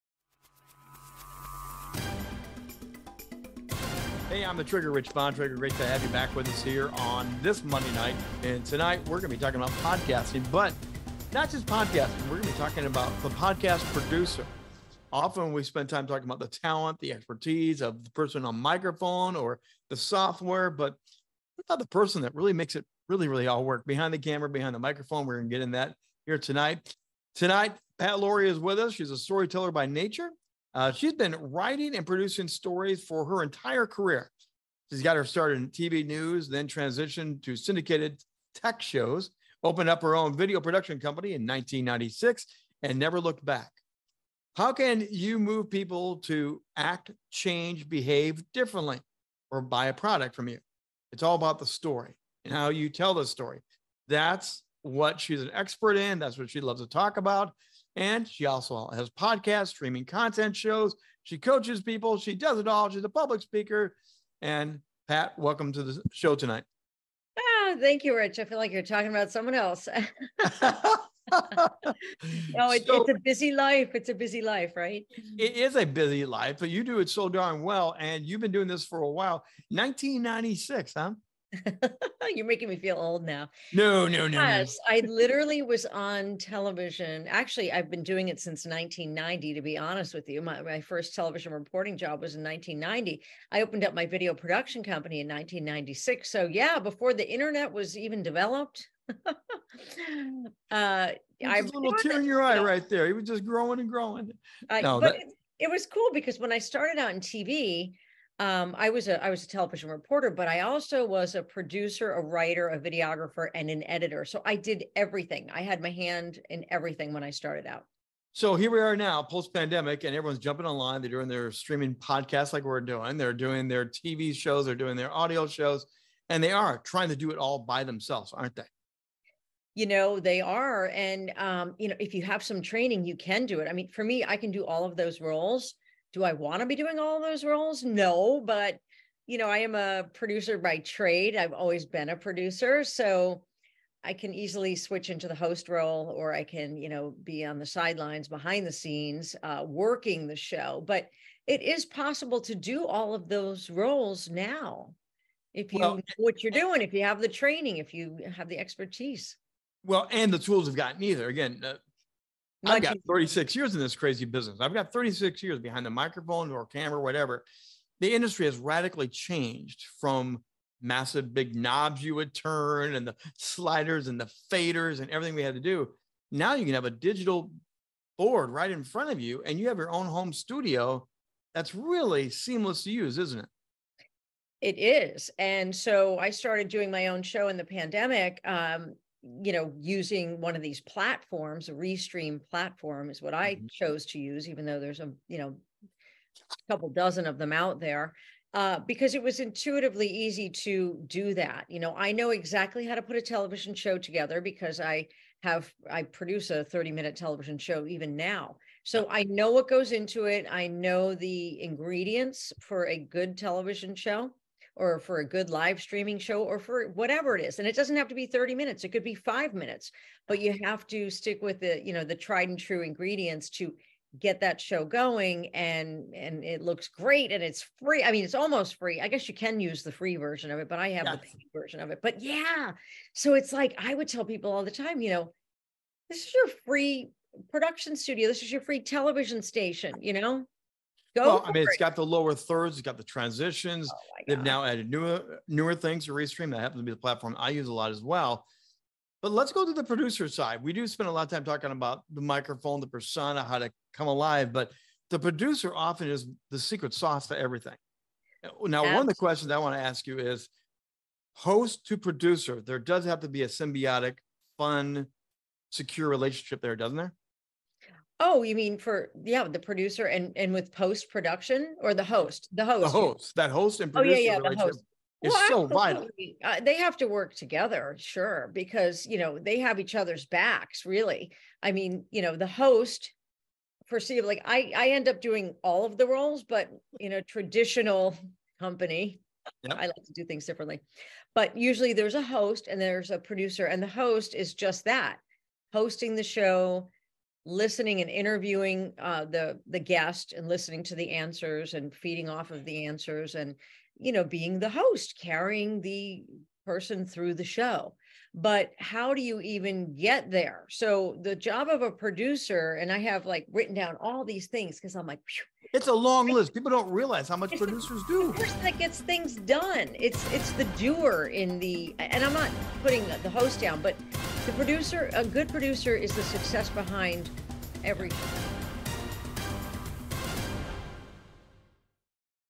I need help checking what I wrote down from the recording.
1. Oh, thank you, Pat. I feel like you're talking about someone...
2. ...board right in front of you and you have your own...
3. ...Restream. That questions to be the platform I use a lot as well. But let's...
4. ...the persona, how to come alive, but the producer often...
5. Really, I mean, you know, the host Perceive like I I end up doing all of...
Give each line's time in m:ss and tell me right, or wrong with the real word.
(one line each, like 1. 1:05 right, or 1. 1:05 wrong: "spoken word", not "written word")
1. 1:07 wrong: "Rich", not "Pat"
2. 2:58 right
3. 4:06 wrong: "happens", not "questions"
4. 4:12 right
5. 4:40 right.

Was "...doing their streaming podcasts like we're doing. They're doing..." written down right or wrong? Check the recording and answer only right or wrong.
right.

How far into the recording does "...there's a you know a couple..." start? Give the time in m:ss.
3:14.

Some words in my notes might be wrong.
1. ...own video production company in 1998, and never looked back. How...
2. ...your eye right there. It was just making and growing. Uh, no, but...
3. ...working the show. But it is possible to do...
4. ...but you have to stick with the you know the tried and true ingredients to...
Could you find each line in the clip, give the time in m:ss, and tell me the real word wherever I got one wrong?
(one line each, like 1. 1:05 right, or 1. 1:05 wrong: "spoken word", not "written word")
1. 0:40 wrong: "1996", not "1998"
2. 1:42 wrong: "growing", not "making"
3. 2:29 right
4. 3:40 right.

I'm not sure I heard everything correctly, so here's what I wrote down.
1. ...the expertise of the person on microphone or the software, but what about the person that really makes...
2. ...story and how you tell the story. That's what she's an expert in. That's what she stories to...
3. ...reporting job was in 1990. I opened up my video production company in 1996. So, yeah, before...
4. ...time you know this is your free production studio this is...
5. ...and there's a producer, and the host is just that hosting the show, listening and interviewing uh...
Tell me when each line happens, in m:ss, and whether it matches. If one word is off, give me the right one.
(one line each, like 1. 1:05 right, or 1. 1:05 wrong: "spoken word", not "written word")
1. 0:17 right
2. 0:51 wrong: "loves", not "stories"
3. 1:31 right
4. 3:54 right
5. 4:52 right.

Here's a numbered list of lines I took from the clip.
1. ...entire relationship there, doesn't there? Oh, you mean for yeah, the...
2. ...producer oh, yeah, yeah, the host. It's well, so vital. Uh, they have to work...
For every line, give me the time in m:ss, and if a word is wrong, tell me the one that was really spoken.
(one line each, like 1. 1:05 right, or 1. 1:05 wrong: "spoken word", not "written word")
1. 4:25 wrong: "secure", not "entire"
2. 4:33 right.